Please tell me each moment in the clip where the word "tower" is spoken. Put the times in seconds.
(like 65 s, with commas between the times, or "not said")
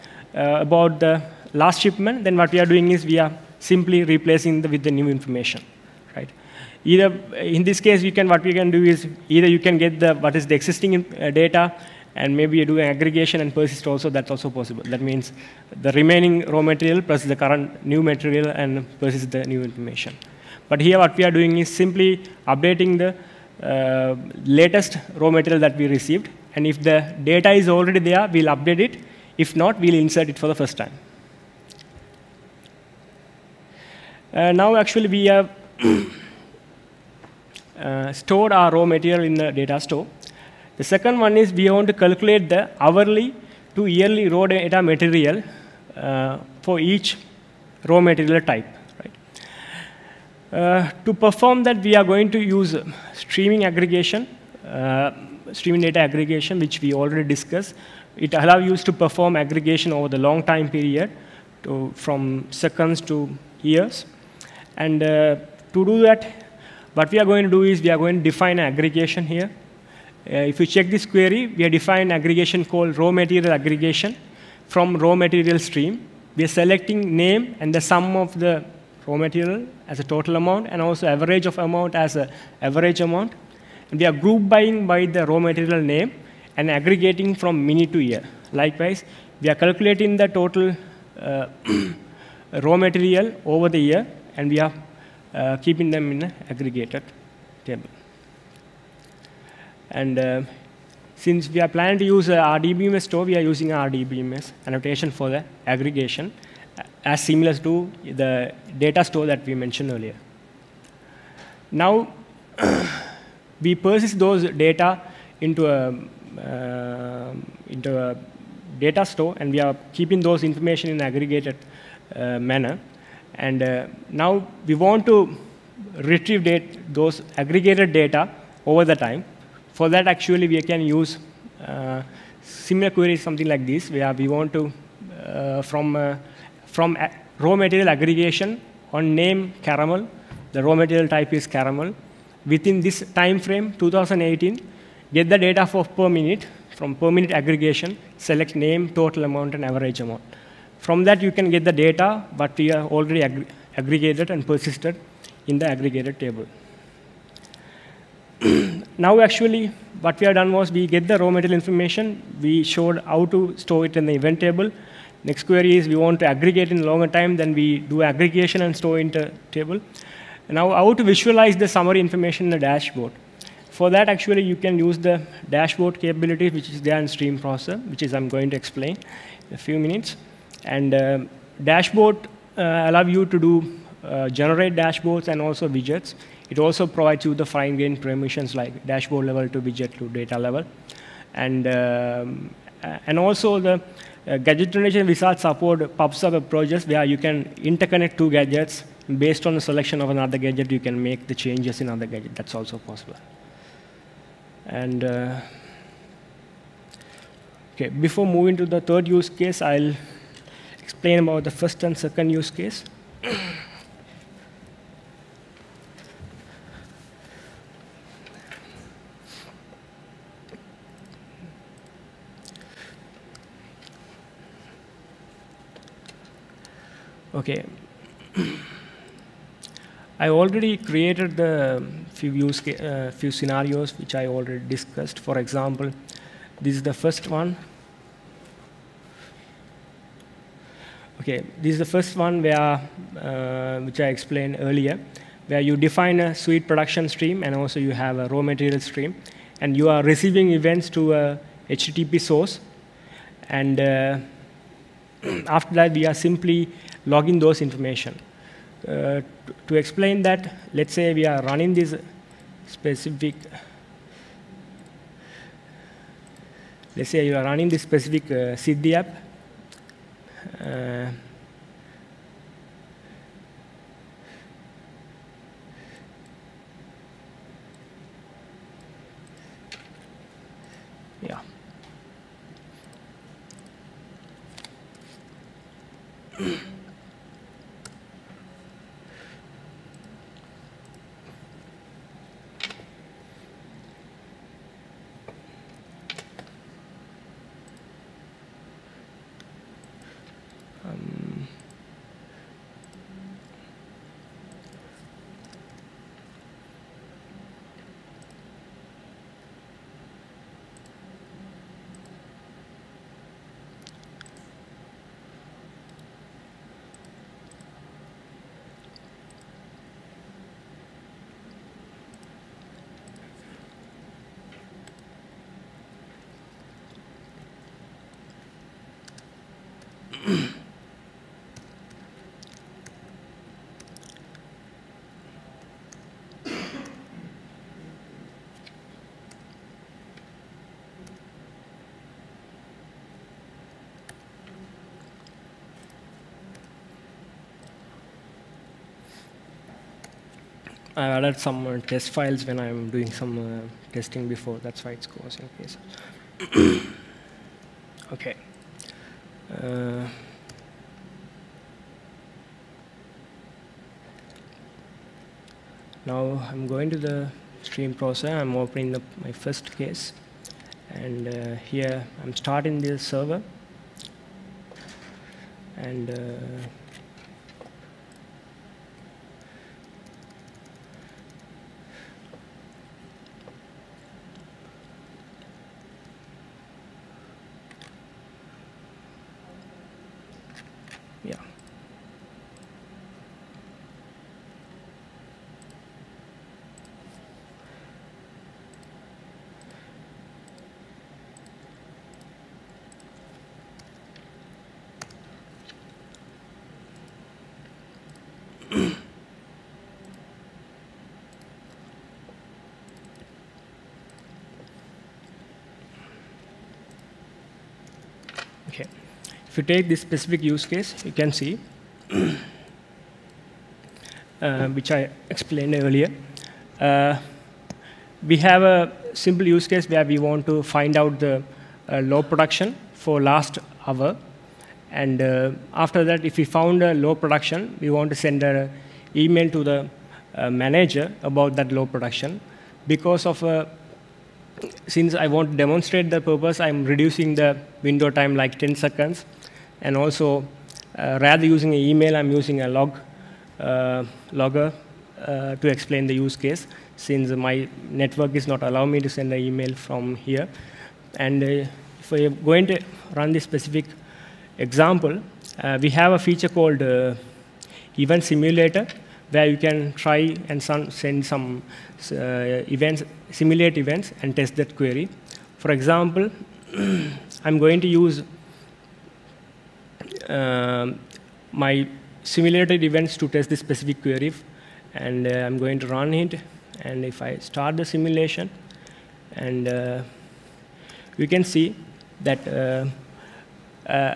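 not said.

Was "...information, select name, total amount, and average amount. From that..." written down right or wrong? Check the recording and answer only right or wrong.
wrong.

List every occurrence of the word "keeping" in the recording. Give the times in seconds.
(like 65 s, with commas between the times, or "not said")
95 s, 119 s.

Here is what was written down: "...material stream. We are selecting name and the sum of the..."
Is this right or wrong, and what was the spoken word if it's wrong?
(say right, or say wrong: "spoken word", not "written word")
right.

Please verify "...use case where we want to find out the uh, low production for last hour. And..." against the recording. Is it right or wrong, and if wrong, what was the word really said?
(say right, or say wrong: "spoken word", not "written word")
right.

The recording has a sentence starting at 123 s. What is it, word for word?
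And uh, now we want to retrieve date, those aggregated data over the time.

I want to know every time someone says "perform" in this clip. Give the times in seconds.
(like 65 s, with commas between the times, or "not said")
51 s, 58 s.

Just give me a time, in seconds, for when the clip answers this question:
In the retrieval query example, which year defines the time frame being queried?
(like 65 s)
143 s.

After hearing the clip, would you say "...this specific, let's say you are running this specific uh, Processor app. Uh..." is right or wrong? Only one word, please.
wrong.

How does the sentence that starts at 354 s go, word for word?
That's why it's causing in case.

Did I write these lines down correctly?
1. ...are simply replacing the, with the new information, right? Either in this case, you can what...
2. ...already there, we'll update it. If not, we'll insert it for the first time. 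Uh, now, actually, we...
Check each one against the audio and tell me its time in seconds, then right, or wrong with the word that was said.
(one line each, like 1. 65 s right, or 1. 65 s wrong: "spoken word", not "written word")
1. 3 s right
2. 27 s right.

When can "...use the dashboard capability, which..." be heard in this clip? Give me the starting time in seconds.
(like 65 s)
174 s.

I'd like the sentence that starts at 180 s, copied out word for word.
And uh, dashboard uh, allow you to do uh, generate dashboards and also widgets.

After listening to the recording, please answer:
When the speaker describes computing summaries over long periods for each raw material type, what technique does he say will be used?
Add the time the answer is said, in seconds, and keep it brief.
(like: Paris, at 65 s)
Streaming aggregation, at 53 s.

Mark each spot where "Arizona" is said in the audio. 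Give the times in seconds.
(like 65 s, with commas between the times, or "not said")
not said.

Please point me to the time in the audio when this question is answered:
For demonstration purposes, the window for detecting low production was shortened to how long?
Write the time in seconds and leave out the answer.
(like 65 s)
448 s.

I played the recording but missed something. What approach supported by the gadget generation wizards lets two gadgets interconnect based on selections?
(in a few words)
PubSub.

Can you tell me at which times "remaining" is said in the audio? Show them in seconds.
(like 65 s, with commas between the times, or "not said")
15 s.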